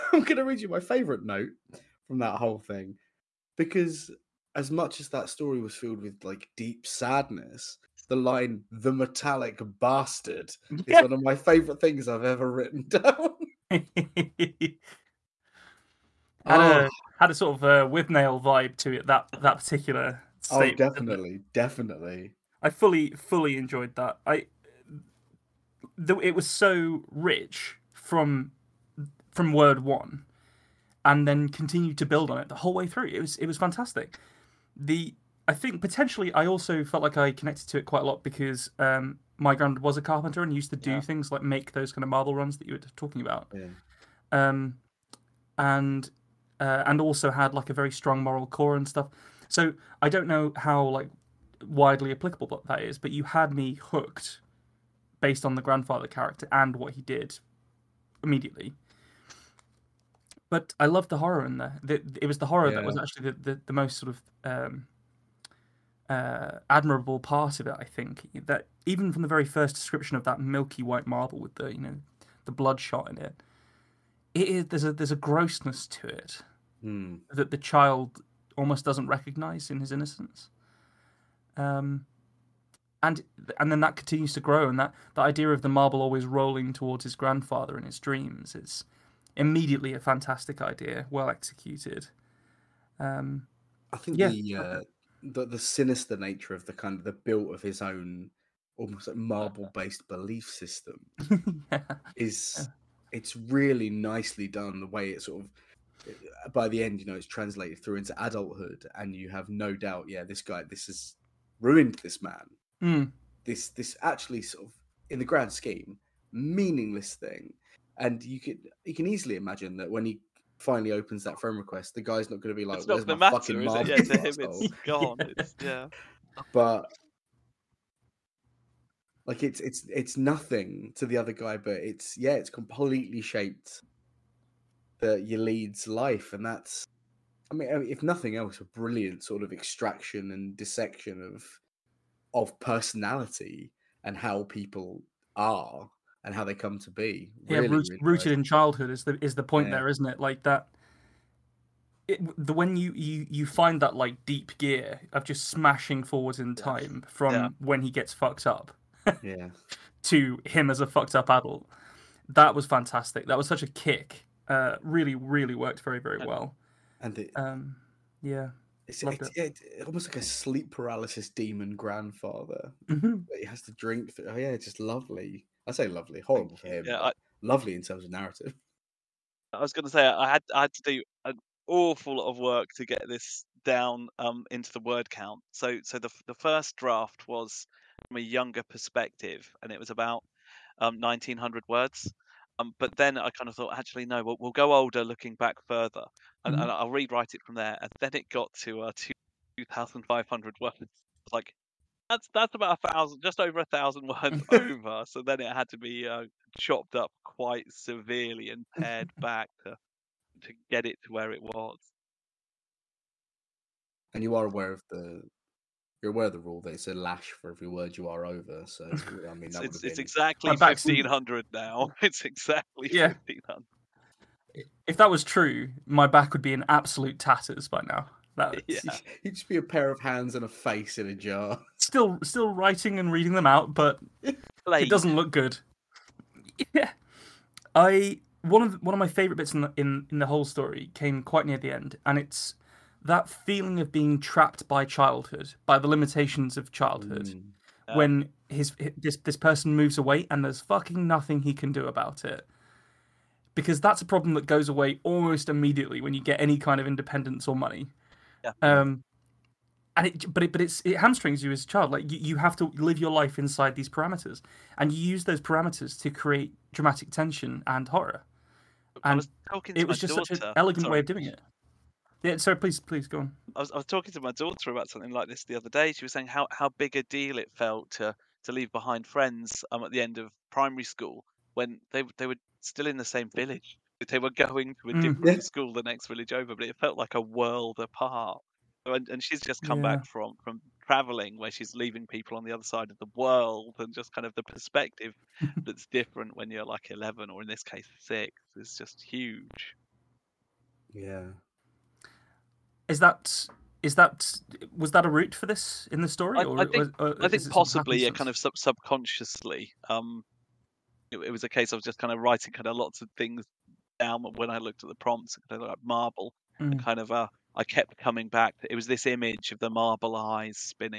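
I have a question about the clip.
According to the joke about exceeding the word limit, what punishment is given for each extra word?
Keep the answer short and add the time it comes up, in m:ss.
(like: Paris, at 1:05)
A lash, at 3:36.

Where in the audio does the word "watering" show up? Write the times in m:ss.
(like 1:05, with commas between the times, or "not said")
not said.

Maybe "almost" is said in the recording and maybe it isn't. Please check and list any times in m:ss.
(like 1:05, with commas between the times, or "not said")
1:18, 1:38, 2:49, 4:15.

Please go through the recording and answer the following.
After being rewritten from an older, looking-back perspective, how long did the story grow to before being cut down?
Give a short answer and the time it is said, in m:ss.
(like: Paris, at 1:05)
2,500 words, at 3:19.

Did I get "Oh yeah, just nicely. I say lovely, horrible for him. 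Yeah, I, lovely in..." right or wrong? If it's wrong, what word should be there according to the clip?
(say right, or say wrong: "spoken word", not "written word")
wrong: "lovely", not "nicely".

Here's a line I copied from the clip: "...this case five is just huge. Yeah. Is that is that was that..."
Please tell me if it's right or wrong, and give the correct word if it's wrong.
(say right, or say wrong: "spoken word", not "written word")
wrong: "six", not "five".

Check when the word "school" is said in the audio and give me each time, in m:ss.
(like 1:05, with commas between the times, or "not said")
4:40, 4:45.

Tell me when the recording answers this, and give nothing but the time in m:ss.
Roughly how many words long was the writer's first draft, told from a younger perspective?
3:11.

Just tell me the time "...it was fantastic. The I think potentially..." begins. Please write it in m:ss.
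0:33.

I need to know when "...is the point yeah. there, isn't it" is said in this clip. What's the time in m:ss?
2:29.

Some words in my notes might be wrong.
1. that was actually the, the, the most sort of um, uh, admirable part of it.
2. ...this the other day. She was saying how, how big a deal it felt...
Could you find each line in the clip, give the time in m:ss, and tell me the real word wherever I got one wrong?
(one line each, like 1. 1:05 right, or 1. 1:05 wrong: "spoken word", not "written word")
1. 1:02 right
2. 4:35 right.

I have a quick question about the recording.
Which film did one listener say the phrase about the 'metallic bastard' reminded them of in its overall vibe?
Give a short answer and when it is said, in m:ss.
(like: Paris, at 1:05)
Withnail, at 0:17.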